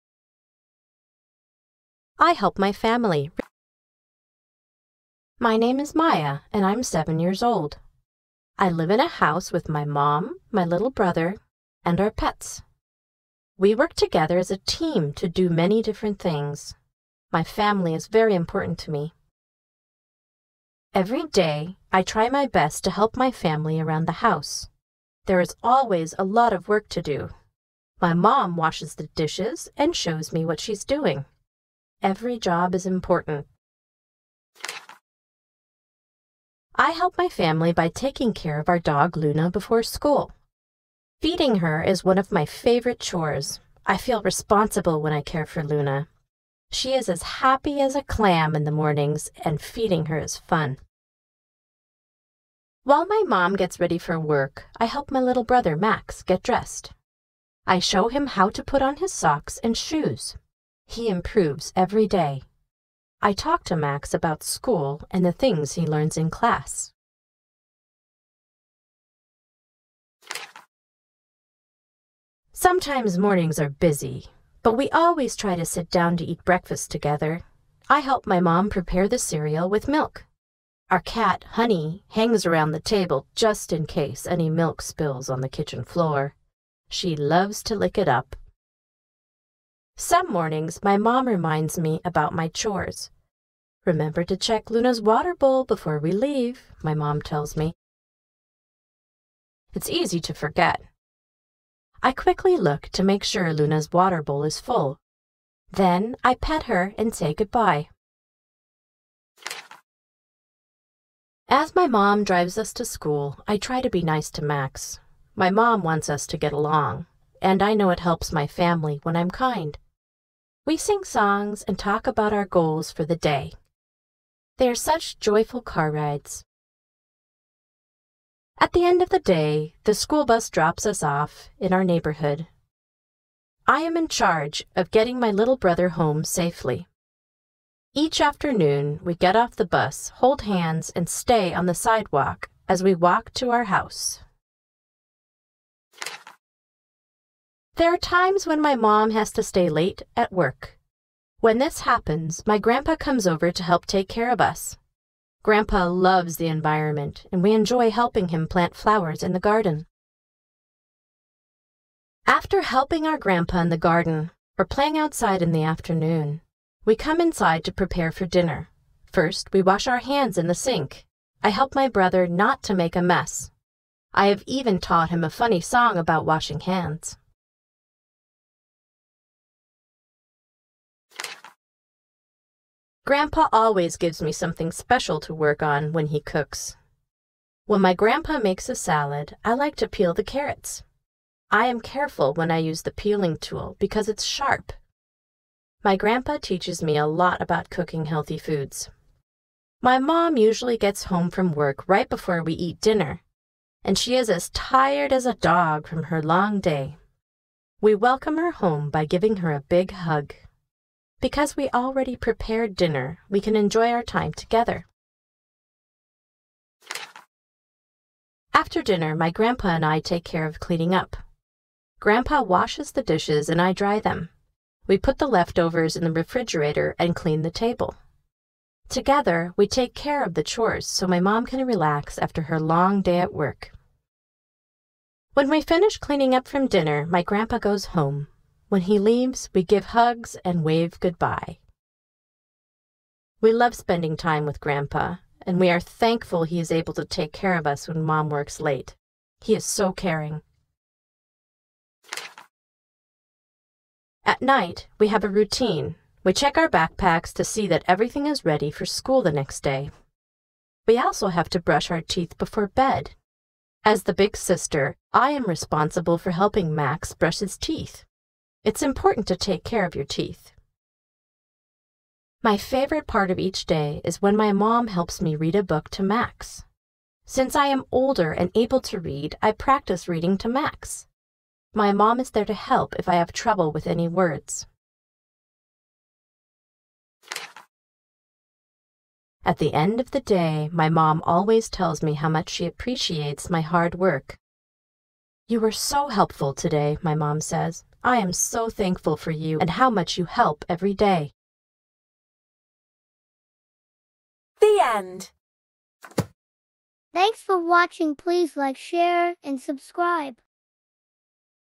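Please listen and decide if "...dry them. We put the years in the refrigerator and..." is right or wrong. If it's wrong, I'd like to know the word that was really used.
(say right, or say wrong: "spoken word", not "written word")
wrong: "leftovers", not "years".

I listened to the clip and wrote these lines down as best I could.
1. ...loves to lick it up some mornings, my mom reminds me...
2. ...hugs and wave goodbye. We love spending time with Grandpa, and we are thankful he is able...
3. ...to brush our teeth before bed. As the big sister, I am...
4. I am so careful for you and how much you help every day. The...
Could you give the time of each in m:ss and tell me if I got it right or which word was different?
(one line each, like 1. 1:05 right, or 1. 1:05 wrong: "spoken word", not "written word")
1. 1:27 right
2. 3:59 right
3. 4:21 right
4. 4:58 wrong: "thankful", not "careful".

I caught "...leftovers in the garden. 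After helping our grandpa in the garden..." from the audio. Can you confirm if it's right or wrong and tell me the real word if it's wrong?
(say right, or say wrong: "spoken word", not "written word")
wrong: "flowers", not "leftovers".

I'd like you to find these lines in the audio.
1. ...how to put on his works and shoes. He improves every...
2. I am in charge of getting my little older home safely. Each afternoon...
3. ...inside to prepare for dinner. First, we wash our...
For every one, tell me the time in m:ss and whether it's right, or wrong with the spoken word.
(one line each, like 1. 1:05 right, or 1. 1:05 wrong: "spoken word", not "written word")
1. 0:58 wrong: "socks", not "works"
2. 2:13 wrong: "brother", not "older"
3. 2:47 right.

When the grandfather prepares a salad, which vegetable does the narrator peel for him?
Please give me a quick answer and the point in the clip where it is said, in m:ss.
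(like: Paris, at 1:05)
Carrots, at 3:10.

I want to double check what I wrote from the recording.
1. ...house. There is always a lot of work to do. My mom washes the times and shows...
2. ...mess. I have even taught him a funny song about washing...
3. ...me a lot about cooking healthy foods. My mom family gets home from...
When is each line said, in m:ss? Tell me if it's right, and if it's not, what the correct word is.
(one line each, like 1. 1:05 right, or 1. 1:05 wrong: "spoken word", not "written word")
1. 0:24 wrong: "dishes", not "times"
2. 2:53 right
3. 3:16 wrong: "usually", not "family".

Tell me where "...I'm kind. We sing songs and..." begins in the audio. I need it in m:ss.
1:59.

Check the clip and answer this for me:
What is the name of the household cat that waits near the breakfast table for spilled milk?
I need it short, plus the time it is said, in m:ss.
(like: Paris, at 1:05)
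Honey, at 1:21.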